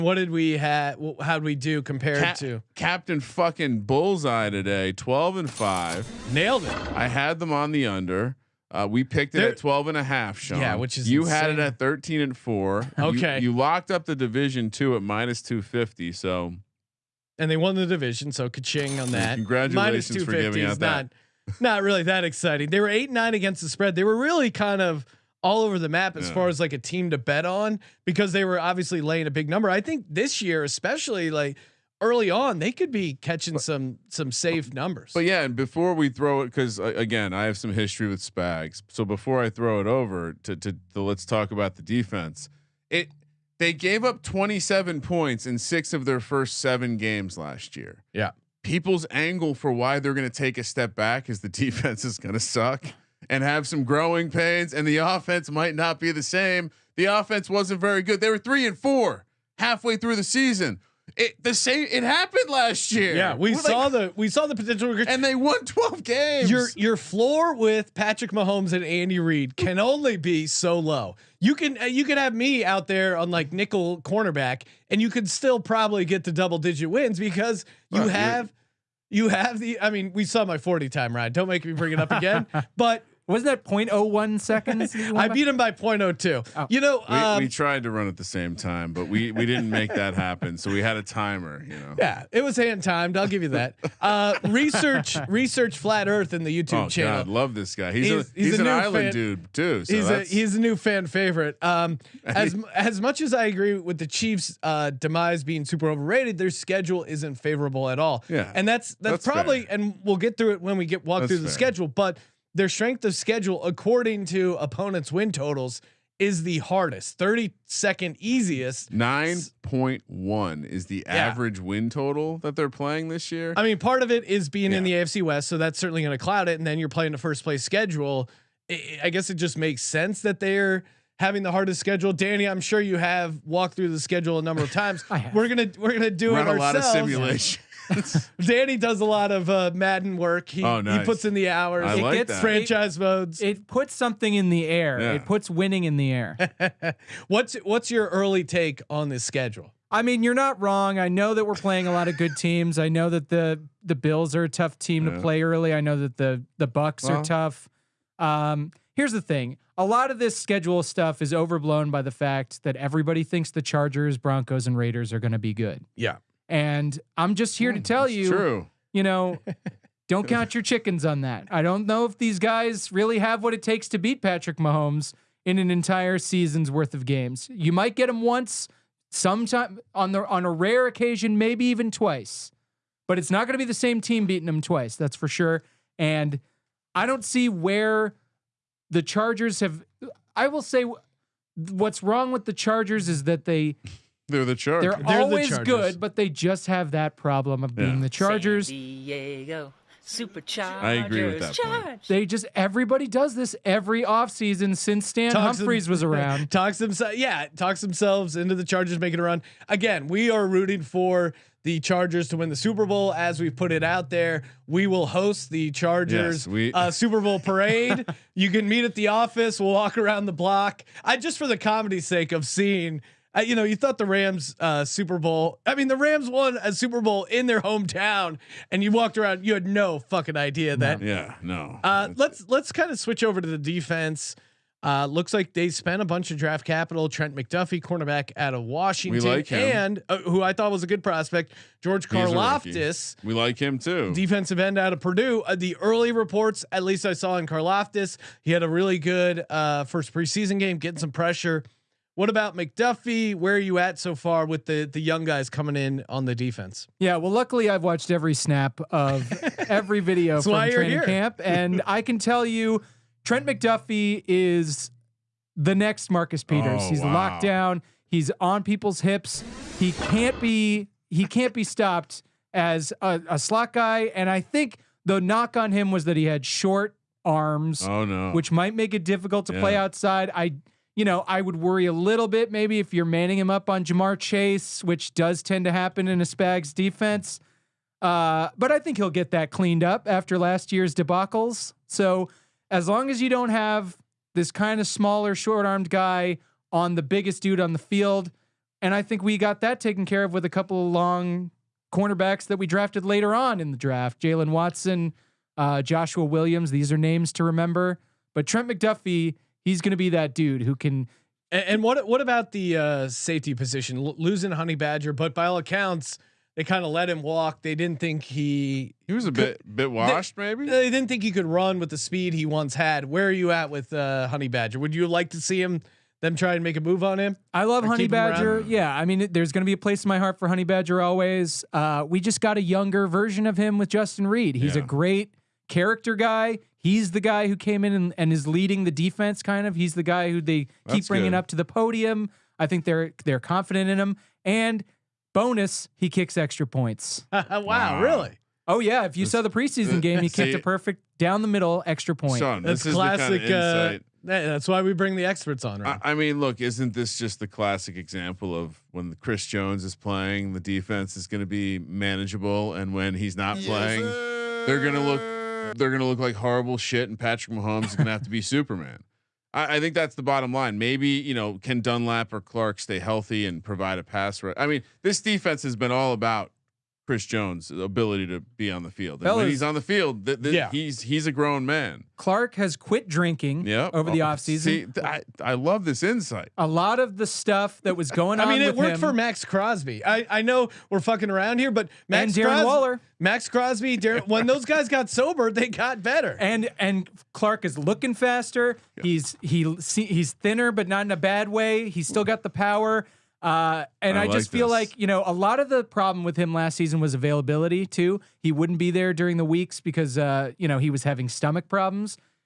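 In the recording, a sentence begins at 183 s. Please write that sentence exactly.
But it's not going to be the same team beating him twice, that's for sure.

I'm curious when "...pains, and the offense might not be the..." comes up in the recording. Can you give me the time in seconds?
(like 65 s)
54 s.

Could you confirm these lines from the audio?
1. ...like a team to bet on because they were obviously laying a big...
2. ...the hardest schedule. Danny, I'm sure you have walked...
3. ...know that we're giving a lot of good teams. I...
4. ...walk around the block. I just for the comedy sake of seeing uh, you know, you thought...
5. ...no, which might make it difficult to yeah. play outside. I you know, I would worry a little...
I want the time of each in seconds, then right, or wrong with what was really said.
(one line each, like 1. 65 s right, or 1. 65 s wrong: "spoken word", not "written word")
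1. 26 s right
2. 131 s right
3. 151 s wrong: "playing", not "giving"
4. 219 s right
5. 278 s right.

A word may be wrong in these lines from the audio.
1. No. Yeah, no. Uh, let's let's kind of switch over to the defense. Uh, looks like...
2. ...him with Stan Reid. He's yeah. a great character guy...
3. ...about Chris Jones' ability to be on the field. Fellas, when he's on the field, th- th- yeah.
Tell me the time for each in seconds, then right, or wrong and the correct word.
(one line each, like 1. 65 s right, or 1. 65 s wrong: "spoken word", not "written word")
1. 231 s right
2. 333 s wrong: "Justin", not "Stan"
3. 376 s right.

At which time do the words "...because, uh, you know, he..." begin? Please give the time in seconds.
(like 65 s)
409 s.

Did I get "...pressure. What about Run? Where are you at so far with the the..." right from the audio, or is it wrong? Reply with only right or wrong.
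wrong.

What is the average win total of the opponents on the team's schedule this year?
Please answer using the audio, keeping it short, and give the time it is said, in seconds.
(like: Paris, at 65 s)
9.1, at 118 s.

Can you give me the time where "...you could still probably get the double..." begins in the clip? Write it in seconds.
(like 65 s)
75 s.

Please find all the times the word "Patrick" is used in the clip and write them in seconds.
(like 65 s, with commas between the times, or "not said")
67 s, 174 s, 367 s.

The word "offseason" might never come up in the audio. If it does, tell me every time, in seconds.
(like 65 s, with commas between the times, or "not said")
204 s, 384 s.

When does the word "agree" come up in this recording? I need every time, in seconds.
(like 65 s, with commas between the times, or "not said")
103 s, 200 s.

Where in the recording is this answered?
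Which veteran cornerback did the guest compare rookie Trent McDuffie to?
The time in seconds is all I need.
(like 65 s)
266 s.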